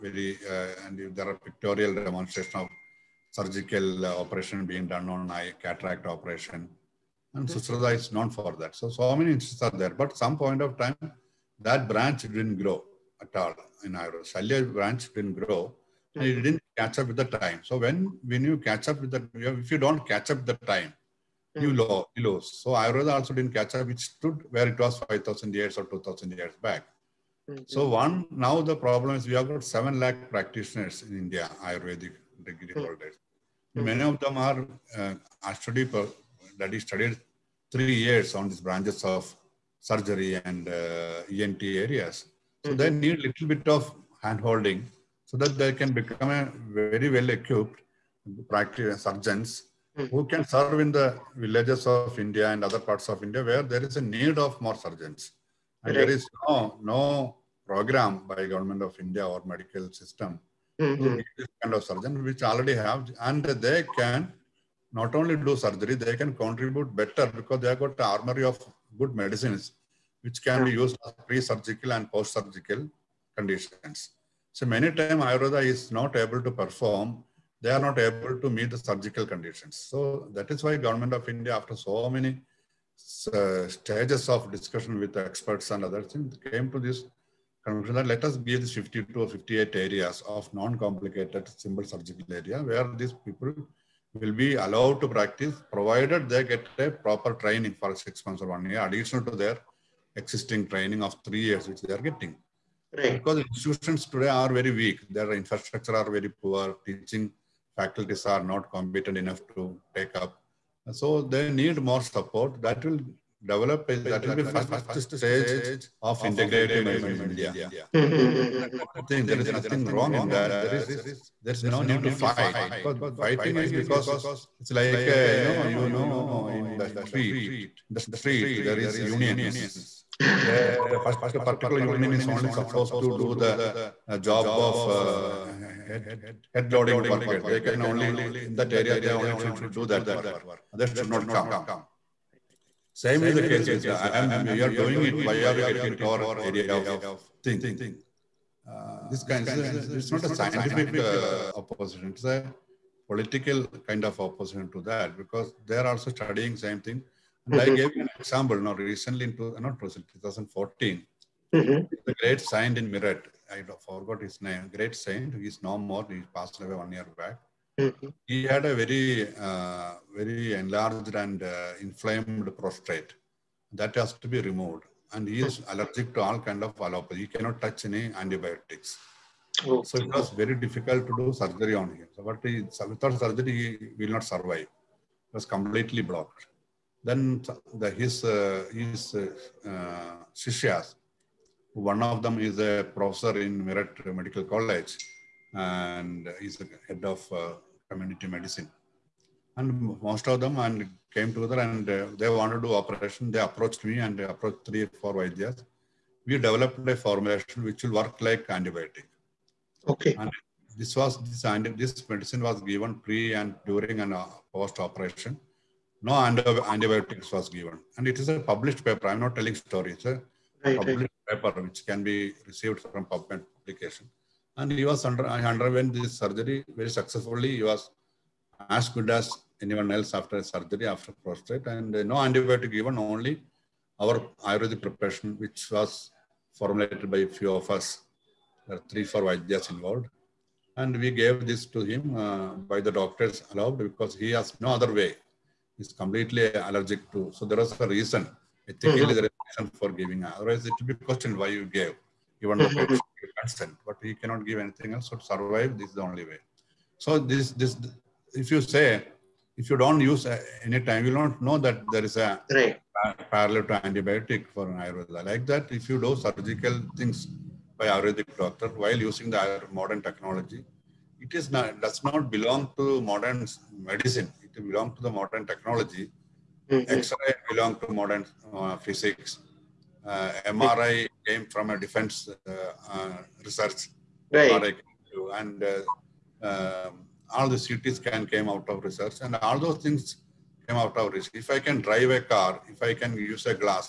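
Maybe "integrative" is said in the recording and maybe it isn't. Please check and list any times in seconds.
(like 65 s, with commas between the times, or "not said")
116 s.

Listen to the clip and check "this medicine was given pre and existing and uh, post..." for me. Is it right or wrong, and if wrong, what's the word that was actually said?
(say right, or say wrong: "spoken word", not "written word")
wrong: "during", not "existing".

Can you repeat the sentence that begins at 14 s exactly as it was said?
Shalya branch didn't grow and it didn't catch up with the time.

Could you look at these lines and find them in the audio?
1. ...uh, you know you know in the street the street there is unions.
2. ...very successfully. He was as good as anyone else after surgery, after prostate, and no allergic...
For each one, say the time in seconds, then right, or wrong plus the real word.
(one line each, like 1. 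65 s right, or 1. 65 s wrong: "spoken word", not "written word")
1. 125 s right
2. 226 s wrong: "antibiotic", not "allergic".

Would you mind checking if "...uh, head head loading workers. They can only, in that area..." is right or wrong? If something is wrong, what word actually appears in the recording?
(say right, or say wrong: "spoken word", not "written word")
right.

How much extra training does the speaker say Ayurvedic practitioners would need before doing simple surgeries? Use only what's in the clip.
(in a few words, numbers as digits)
six months or one year.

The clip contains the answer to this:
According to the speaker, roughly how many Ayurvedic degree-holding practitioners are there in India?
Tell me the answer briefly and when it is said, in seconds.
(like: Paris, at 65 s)
7 lakh, at 29 s.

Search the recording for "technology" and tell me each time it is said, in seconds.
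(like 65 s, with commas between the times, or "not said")
270 s, 275 s.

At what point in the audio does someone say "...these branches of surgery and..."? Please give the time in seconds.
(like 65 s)
38 s.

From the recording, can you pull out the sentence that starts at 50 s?
who can serve in the villages of India and other parts of India where there is a need of more surgeons.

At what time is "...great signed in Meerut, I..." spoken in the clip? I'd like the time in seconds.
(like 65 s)
162 s.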